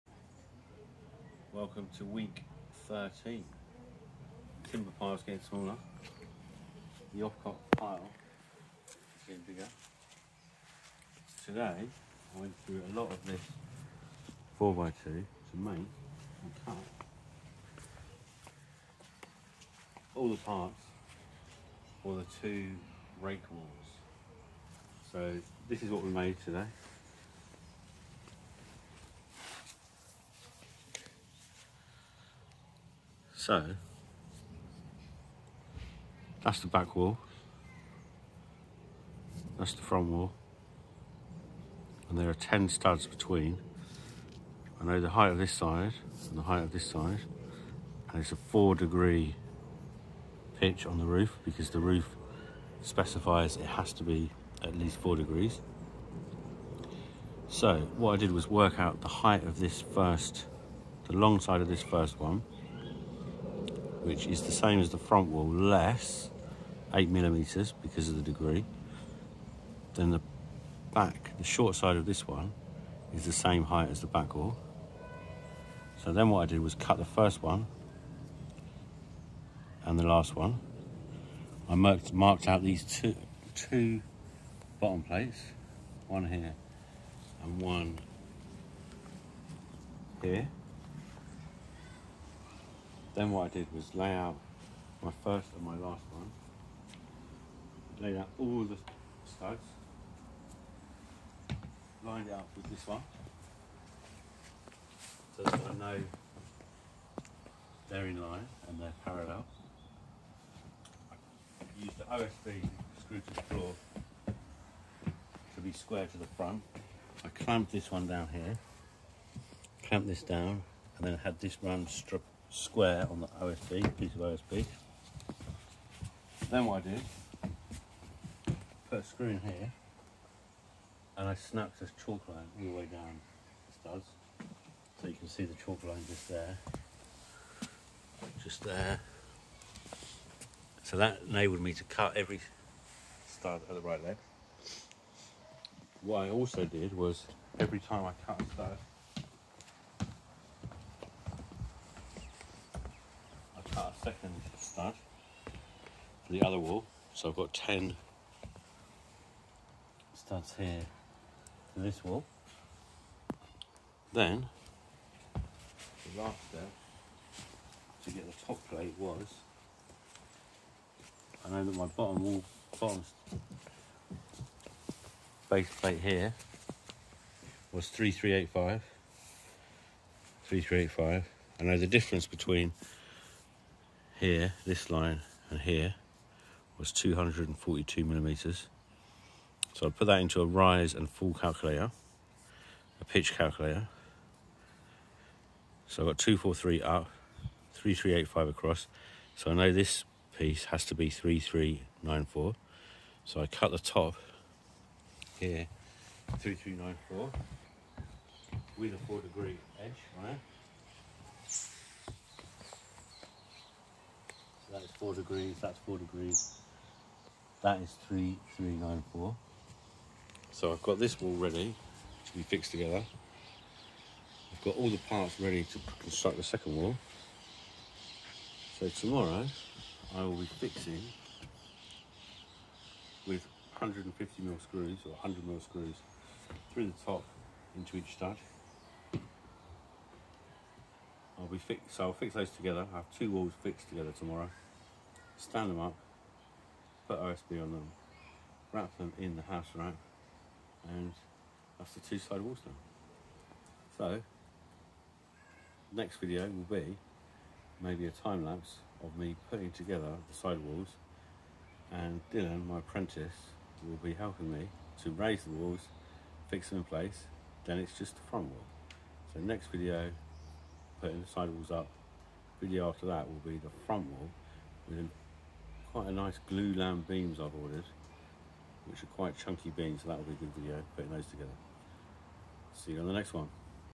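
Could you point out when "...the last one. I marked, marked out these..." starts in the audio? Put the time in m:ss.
1:19.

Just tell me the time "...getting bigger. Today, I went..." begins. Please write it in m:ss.
0:09.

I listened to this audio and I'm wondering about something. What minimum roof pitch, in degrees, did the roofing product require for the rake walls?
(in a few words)
4 degrees.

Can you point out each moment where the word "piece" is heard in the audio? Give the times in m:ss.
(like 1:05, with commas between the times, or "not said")
2:03, 3:20.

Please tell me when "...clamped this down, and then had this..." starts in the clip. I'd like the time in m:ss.
1:59.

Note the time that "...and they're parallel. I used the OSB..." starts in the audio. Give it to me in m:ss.
1:48.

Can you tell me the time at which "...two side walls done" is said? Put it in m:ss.
4:11.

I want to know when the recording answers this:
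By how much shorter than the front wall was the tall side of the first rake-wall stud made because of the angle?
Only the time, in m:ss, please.
1:06.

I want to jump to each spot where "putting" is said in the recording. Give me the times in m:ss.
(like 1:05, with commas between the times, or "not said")
4:19, 4:31, 4:40.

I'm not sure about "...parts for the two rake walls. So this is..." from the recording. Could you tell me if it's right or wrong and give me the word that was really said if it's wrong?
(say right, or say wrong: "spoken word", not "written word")
right.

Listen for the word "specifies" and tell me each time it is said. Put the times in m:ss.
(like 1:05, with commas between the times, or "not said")
0:52.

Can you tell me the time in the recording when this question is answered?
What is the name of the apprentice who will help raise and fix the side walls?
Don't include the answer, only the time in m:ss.
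4:22.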